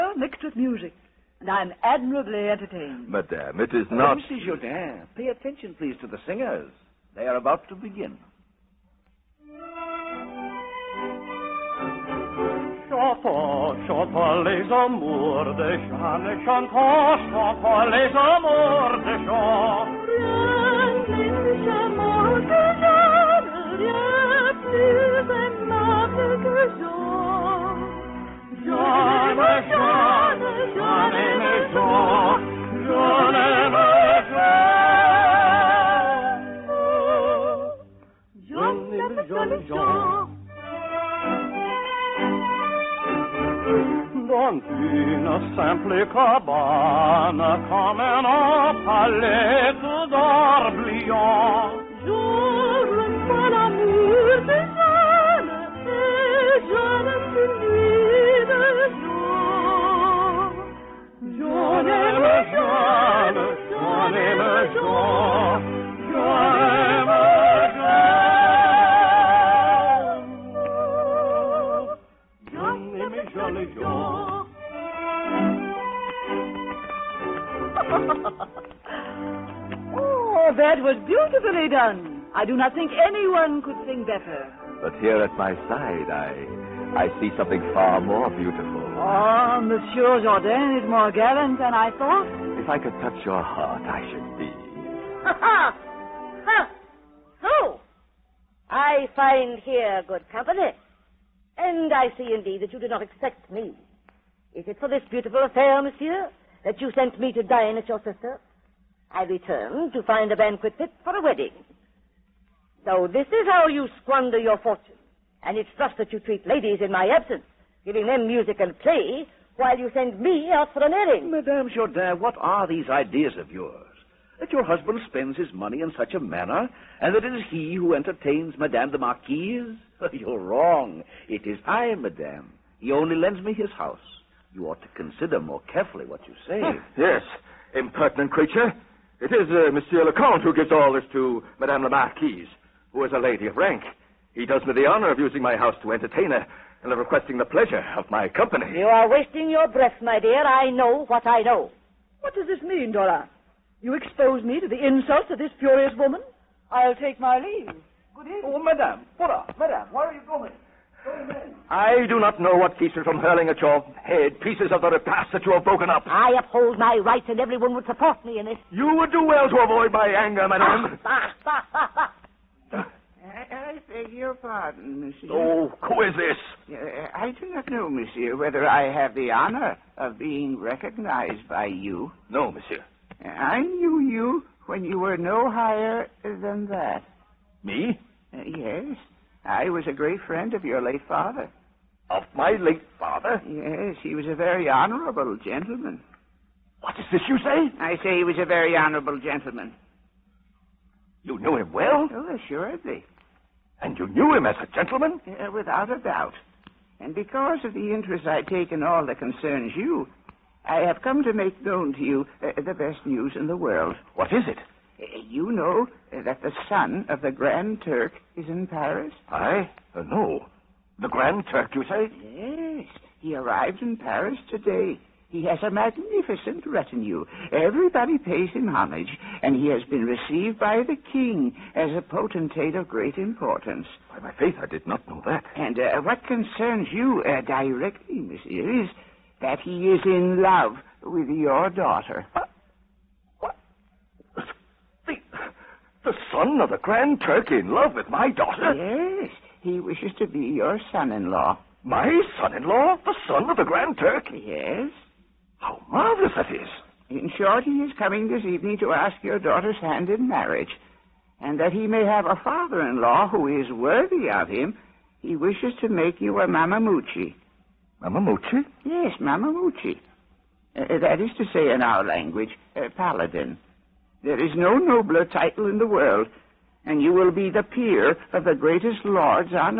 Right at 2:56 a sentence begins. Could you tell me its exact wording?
Uh, I do not know, monsieur, whether I have the honor of being recognized by you.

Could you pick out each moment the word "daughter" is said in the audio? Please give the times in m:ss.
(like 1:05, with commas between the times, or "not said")
4:01, 4:08, 4:19.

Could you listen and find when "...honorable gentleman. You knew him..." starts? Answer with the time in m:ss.
3:18.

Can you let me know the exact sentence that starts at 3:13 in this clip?
Yes, he was a very honorable gentleman.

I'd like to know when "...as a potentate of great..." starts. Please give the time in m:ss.
3:51.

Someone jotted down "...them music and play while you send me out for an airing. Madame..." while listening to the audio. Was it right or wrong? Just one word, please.
right.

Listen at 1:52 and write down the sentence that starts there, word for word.
So this is how you squander your fortune.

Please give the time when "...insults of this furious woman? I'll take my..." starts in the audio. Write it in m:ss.
2:34.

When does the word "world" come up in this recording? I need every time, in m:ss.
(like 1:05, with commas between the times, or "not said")
3:33, 4:35.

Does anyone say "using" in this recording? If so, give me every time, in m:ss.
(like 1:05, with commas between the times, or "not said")
2:25.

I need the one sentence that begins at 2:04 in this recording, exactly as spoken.
That your husband spends his money in such a manner, and that it is he who entertains Madame the Marquise?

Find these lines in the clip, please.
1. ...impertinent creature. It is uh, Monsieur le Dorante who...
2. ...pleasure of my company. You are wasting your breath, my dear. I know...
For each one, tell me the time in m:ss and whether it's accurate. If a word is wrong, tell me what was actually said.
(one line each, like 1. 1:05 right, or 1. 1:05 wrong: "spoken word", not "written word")
1. 2:17 wrong: "Comte", not "Dorante"
2. 2:27 right.